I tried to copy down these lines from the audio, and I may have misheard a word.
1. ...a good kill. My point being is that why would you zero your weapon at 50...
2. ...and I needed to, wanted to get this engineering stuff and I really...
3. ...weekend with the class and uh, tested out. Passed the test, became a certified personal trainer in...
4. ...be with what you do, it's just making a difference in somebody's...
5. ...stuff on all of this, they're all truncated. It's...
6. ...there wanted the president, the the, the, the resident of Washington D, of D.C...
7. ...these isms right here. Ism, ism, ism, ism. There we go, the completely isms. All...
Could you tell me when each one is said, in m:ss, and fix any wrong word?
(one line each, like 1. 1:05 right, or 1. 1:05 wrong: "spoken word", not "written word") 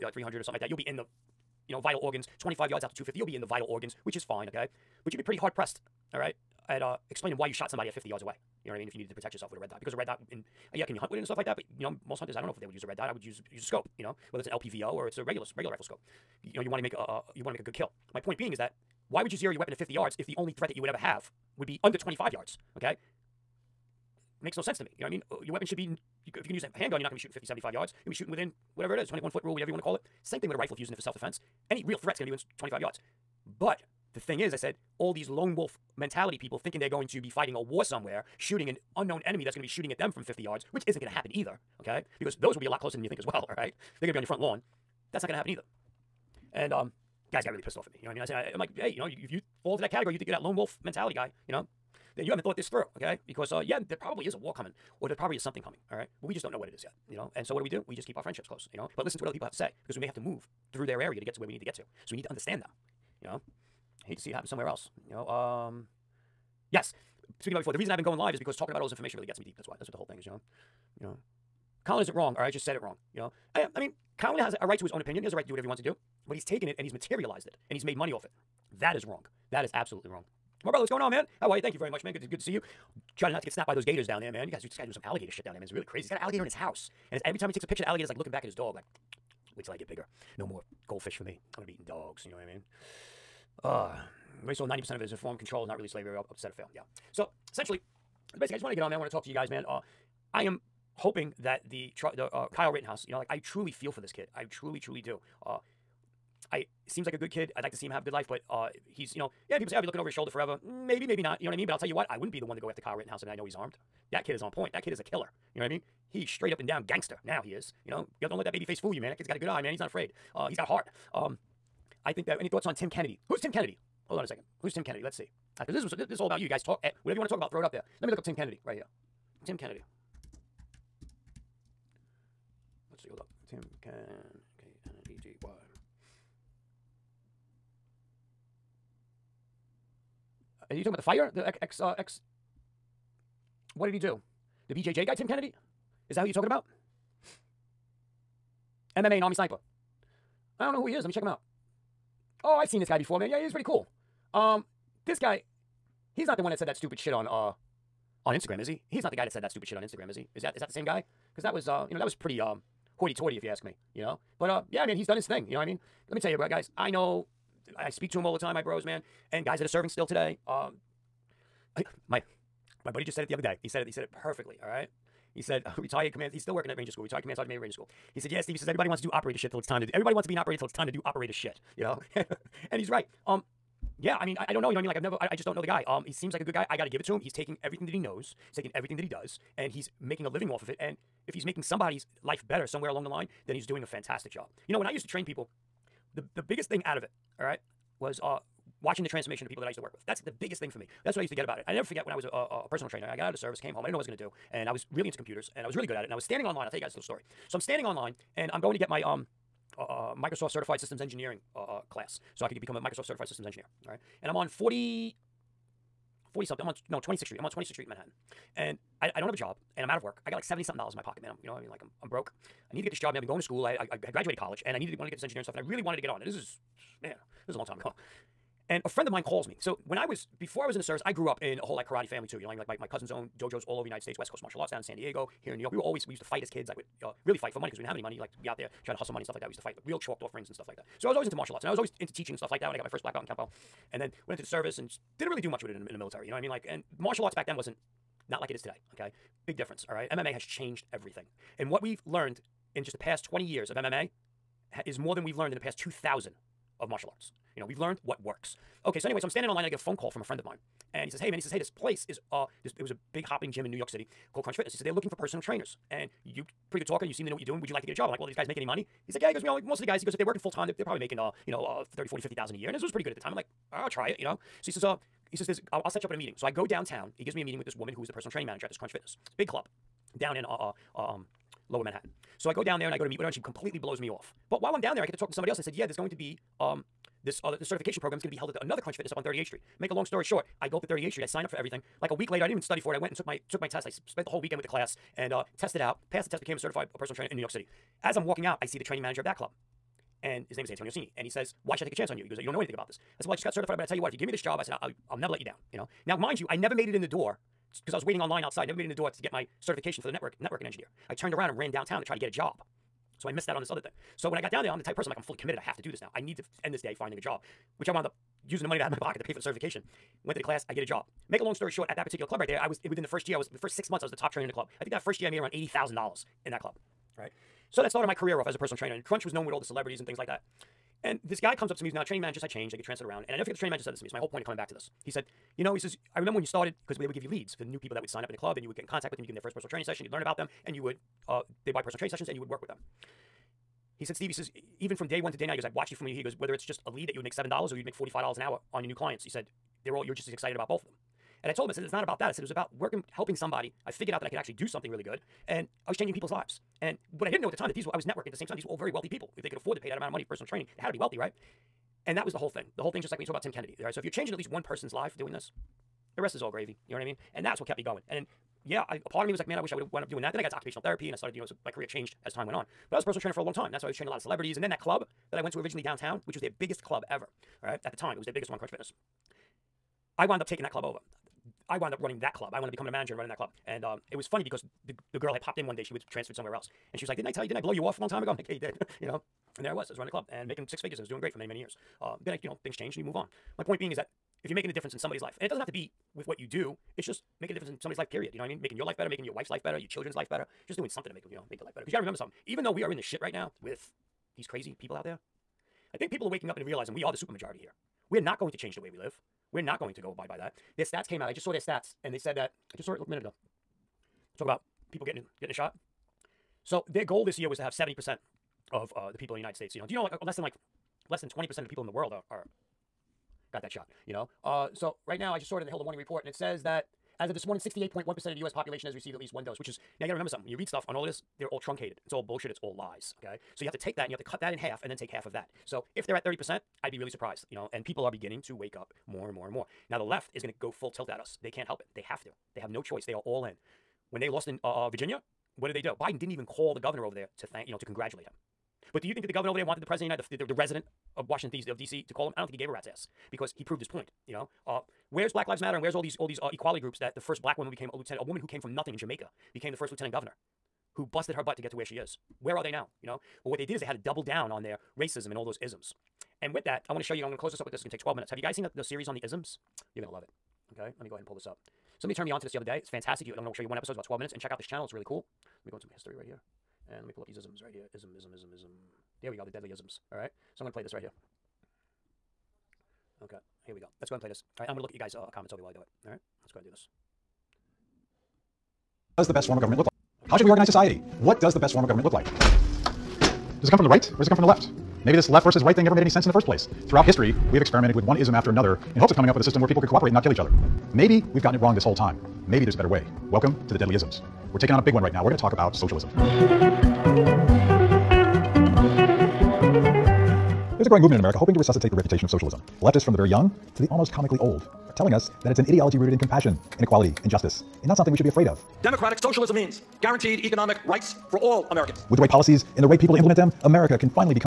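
1. 0:17 right
2. 3:44 right
3. 4:54 right
4. 6:35 right
5. 7:10 right
6. 7:29 right
7. 7:57 wrong: "deadly", not "completely".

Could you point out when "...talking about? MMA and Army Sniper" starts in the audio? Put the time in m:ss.
2:26.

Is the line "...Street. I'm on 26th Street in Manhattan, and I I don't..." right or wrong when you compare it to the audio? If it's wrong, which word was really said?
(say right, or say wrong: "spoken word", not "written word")
right.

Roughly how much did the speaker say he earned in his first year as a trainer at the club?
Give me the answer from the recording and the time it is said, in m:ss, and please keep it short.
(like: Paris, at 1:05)
$80,000, at 5:25.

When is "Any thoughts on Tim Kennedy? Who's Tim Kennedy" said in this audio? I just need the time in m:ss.
2:02.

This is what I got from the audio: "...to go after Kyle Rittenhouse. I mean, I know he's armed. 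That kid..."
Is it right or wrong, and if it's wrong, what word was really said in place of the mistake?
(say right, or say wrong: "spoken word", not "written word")
right.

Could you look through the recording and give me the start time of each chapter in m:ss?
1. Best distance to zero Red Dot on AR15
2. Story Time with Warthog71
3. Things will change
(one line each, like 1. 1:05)
1. 0:09
2. 3:20
3. 6:41.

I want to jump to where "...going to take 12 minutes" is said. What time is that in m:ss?
7:47.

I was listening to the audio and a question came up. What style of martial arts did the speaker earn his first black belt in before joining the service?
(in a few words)
Kempo.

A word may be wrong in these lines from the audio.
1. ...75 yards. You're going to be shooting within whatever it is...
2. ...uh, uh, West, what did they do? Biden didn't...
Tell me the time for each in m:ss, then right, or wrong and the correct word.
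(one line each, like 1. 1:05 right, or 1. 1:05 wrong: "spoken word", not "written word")
1. 0:27 right
2. 7:24 wrong: "Virginia", not "West".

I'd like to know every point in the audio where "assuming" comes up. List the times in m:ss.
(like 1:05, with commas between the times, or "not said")
not said.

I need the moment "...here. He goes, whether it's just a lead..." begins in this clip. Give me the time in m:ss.
5:46.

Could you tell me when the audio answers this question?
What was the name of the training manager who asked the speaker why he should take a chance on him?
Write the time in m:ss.
5:00.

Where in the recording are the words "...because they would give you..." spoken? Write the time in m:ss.
5:36.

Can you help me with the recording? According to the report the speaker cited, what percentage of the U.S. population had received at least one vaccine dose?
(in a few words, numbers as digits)
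68.1%.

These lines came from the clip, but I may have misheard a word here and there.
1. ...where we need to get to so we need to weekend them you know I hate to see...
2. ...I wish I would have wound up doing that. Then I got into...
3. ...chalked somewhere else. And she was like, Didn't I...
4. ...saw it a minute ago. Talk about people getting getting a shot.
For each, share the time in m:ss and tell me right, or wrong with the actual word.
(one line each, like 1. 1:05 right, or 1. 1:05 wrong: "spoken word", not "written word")
1. 1:01 wrong: "understand", not "weekend"
2. 6:09 right
3. 6:26 wrong: "transferred", not "chalked"
4. 6:52 right.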